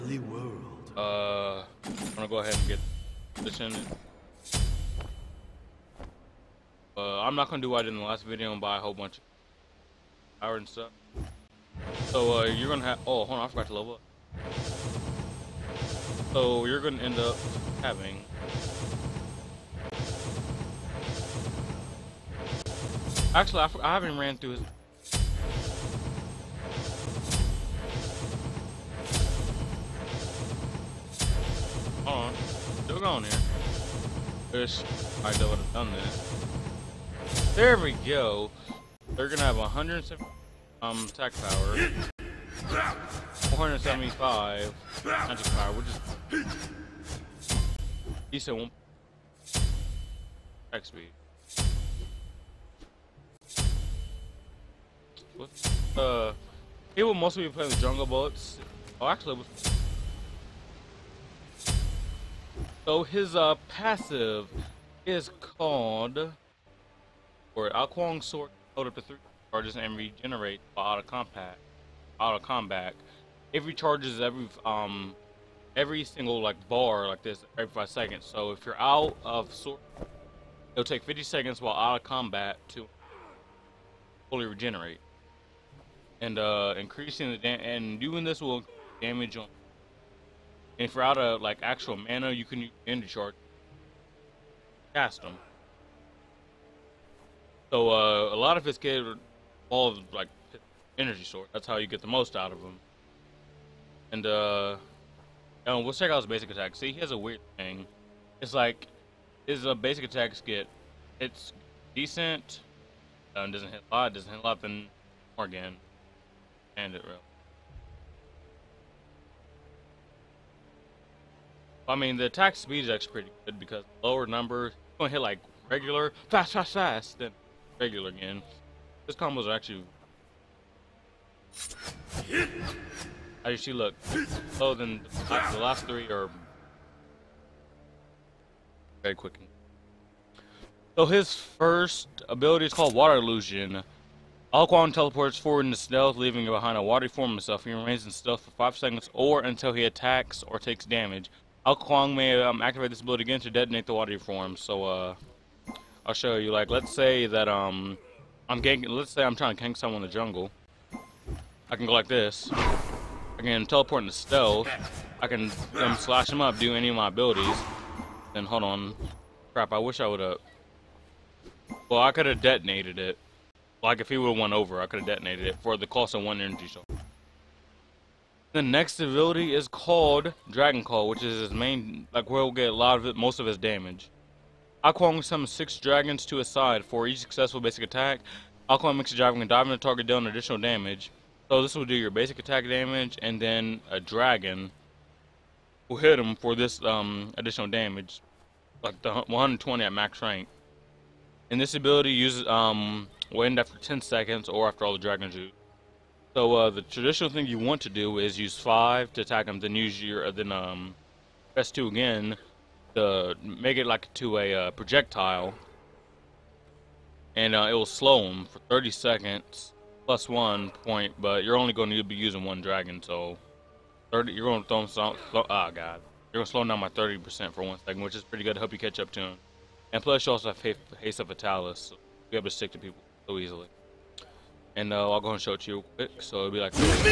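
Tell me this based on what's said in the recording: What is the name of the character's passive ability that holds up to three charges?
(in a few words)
Alquang Sword.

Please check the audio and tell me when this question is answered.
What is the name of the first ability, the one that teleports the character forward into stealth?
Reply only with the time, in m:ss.
2:22.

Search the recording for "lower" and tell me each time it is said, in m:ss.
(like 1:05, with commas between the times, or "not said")
2:04.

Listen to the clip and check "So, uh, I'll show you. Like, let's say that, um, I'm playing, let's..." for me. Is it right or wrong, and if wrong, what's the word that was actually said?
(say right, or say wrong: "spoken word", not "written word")
wrong: "ganking", not "playing".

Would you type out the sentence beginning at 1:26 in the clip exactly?
And uh, increasing the and doing this will damage on.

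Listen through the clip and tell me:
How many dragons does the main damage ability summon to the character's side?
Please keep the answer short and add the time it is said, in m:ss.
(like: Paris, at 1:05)
6, at 3:05.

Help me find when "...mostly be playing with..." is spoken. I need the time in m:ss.
0:57.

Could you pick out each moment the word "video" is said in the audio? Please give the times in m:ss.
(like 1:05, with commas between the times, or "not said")
0:08.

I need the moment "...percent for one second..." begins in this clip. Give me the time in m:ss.
3:47.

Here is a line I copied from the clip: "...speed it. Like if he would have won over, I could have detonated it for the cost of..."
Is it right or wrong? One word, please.
wrong.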